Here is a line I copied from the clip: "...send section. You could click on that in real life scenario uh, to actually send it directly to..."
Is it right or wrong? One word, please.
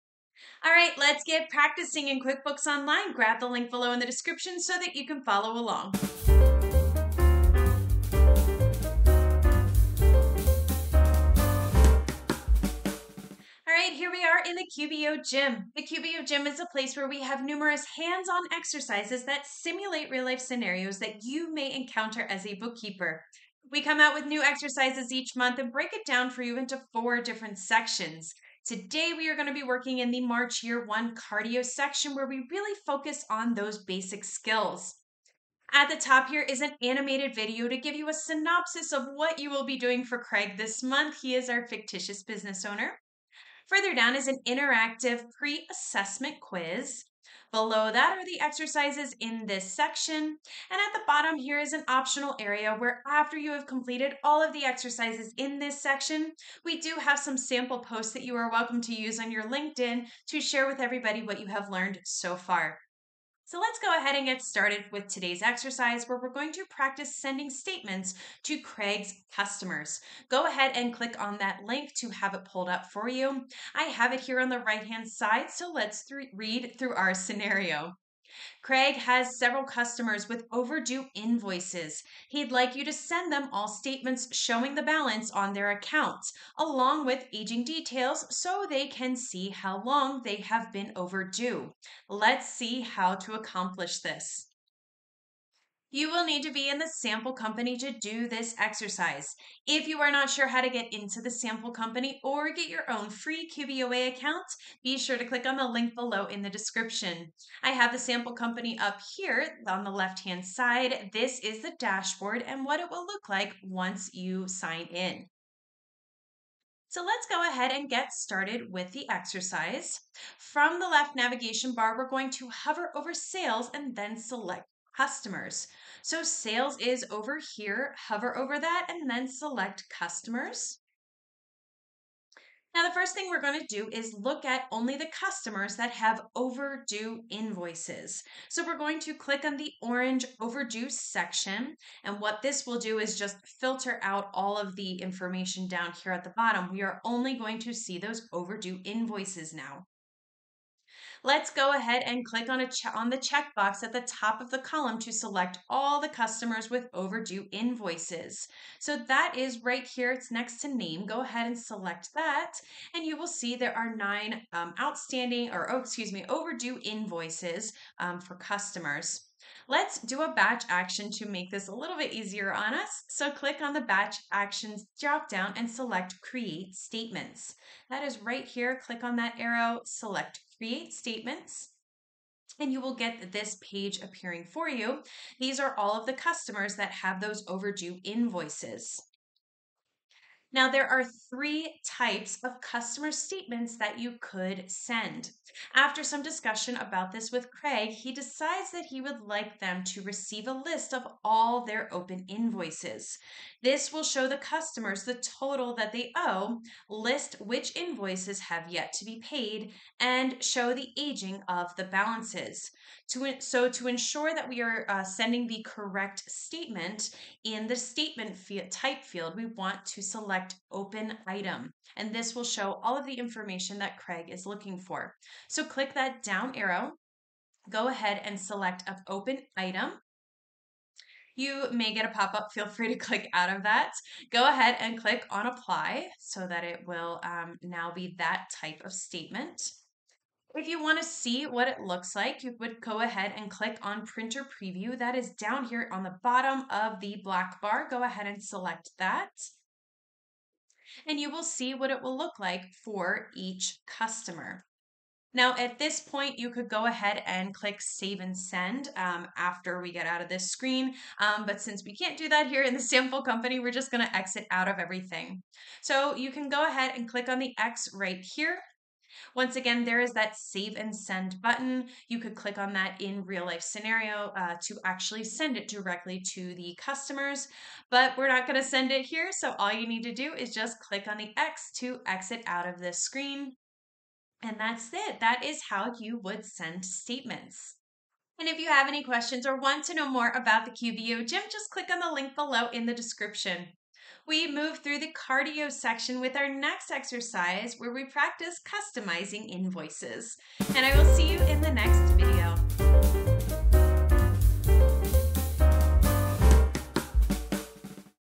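wrong.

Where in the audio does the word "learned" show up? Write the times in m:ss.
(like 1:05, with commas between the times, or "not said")
1:01.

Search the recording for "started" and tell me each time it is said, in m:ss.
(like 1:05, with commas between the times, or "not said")
1:04, 1:58.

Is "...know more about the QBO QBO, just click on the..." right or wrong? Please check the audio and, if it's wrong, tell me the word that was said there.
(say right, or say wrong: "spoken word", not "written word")
wrong: "Gym", not "QBO".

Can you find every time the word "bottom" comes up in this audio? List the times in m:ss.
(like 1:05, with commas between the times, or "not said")
0:51, 2:26, 4:06.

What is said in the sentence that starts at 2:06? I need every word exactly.
So sales is over here, hover over that, and then select customers.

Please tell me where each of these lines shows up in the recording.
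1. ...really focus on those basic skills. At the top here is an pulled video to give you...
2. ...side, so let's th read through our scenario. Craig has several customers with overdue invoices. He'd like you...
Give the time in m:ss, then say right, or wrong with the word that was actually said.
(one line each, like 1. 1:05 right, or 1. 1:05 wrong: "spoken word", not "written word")
1. 0:32 wrong: "animated", not "pulled"
2. 1:15 right.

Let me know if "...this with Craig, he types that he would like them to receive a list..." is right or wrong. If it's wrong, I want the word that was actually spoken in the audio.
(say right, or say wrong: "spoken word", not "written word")
wrong: "decides", not "types".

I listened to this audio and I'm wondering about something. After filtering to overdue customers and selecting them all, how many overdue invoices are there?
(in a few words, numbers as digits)
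9.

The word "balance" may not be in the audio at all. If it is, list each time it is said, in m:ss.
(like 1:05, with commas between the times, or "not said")
1:24, 3:31.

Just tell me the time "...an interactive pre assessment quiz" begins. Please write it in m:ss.
0:44.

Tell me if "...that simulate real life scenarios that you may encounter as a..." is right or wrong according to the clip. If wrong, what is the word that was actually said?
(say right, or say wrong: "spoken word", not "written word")
right.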